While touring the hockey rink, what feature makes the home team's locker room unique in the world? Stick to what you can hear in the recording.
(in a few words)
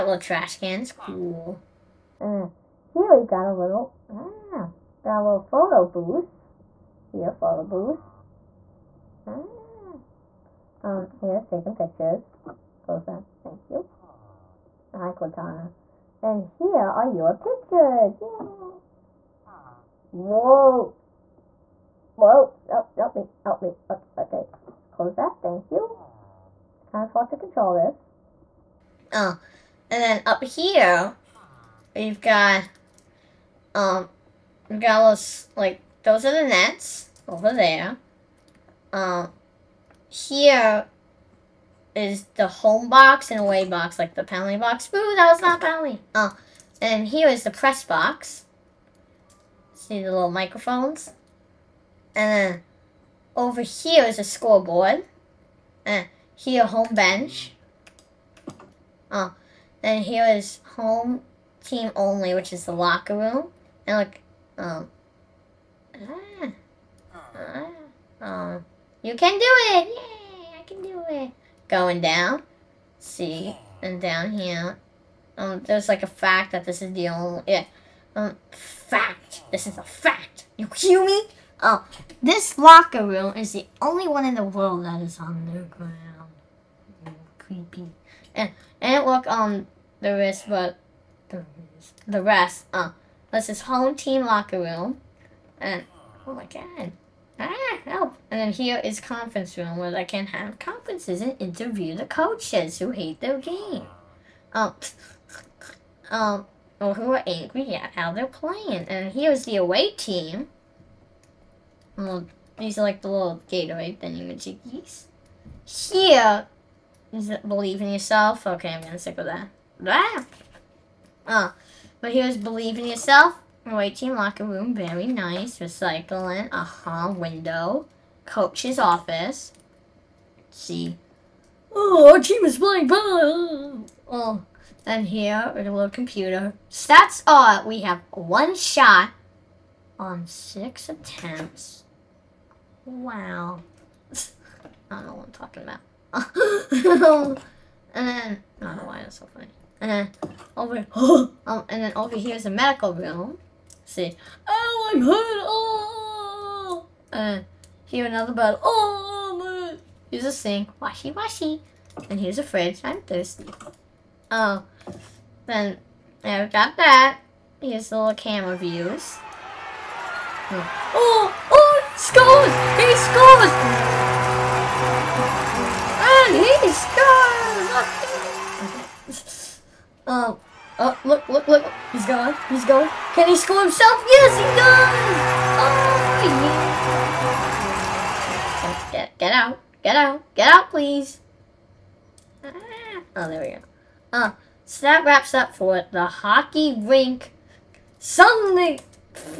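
underground.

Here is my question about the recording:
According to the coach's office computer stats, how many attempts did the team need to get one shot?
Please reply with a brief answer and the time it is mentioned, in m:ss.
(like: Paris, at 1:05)
6, at 2:20.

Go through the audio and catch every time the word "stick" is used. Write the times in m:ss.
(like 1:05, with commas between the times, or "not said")
1:58.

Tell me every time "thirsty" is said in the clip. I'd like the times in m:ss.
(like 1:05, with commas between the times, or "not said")
2:43.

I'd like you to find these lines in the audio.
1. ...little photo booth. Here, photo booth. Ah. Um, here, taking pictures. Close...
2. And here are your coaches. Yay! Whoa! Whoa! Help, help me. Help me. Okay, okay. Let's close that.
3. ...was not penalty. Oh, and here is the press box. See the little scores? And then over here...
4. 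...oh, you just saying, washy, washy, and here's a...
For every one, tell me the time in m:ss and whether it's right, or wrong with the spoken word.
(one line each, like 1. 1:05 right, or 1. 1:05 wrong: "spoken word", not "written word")
1. 0:05 right
2. 0:16 wrong: "pictures", not "coaches"
3. 0:45 wrong: "microphones", not "scores"
4. 2:38 right.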